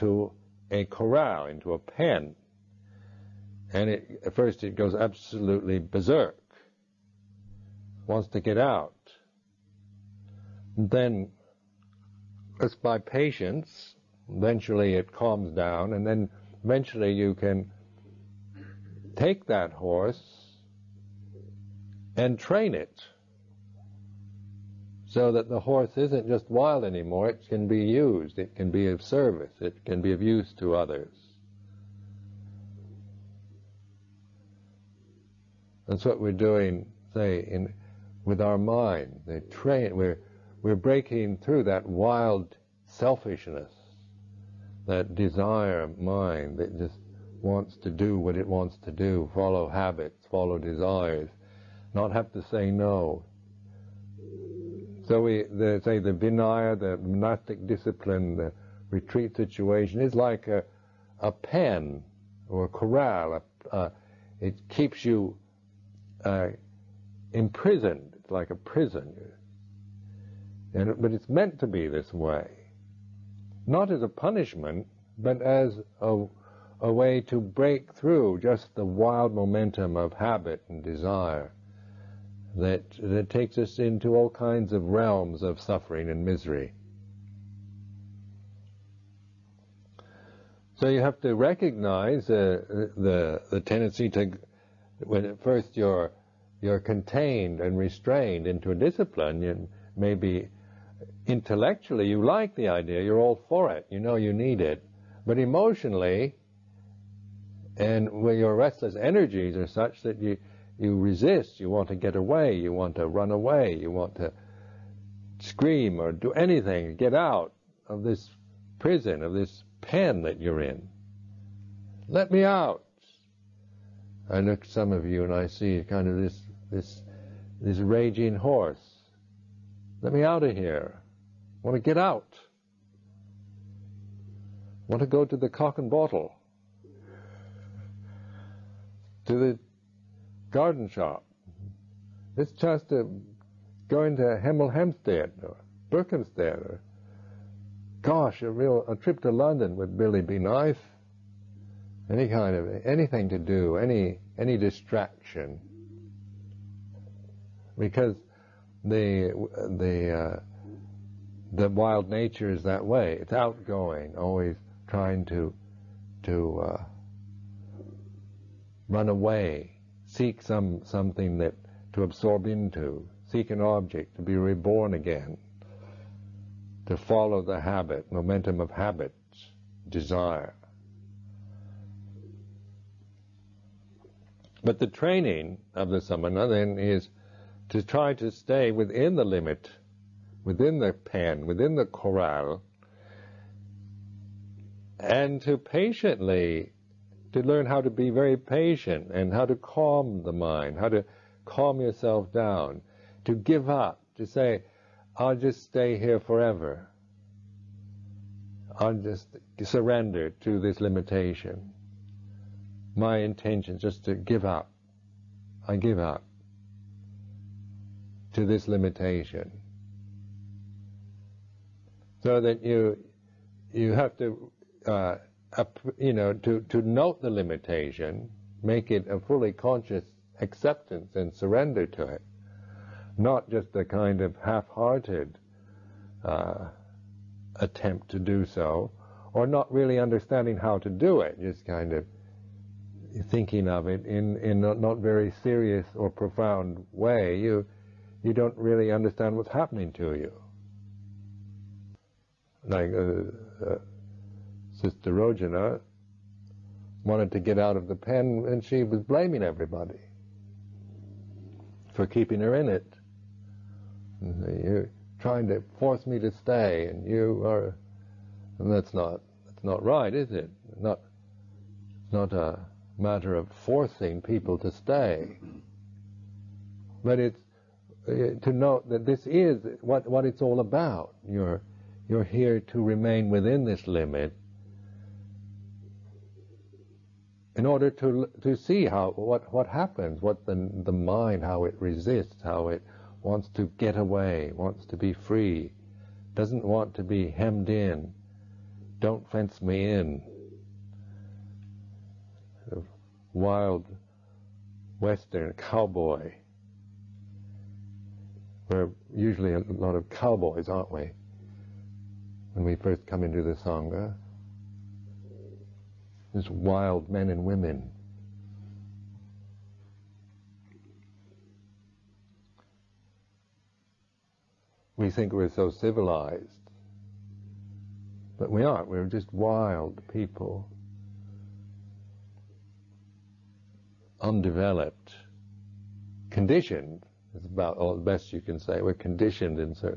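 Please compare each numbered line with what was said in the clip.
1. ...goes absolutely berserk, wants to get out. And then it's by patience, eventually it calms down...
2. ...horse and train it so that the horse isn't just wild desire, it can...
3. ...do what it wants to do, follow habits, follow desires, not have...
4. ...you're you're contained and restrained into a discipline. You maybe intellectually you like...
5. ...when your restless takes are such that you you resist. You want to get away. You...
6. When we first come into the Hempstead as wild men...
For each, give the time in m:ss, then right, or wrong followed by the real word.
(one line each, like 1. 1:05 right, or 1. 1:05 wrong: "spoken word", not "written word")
1. 0:04 right
2. 0:19 wrong: "anymore", not "desire"
3. 0:47 right
4. 1:35 right
5. 1:48 wrong: "energies", not "takes"
6. 5:12 wrong: "Sangha", not "Hempstead".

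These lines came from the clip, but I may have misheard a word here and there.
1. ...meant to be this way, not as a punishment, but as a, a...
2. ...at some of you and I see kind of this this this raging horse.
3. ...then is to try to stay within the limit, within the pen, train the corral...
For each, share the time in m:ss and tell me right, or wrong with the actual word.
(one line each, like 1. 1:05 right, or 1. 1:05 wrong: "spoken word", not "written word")
1. 1:11 right
2. 2:04 right
3. 3:06 wrong: "within", not "train".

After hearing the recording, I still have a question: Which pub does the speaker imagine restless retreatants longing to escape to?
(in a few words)
The Cock and Bottle.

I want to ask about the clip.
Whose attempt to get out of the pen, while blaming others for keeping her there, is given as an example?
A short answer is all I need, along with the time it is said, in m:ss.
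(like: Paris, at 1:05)
Sister Rojana, at 4:14.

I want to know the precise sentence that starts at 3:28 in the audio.
I'll just surrender to this limitation.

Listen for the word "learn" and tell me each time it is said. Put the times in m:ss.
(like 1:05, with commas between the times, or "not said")
3:17.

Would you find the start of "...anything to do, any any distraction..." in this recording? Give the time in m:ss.
2:32.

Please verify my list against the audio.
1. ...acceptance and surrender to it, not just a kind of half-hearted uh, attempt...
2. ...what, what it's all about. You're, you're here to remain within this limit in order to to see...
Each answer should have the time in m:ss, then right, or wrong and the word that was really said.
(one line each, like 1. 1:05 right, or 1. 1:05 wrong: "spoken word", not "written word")
1. 3:50 right
2. 4:39 right.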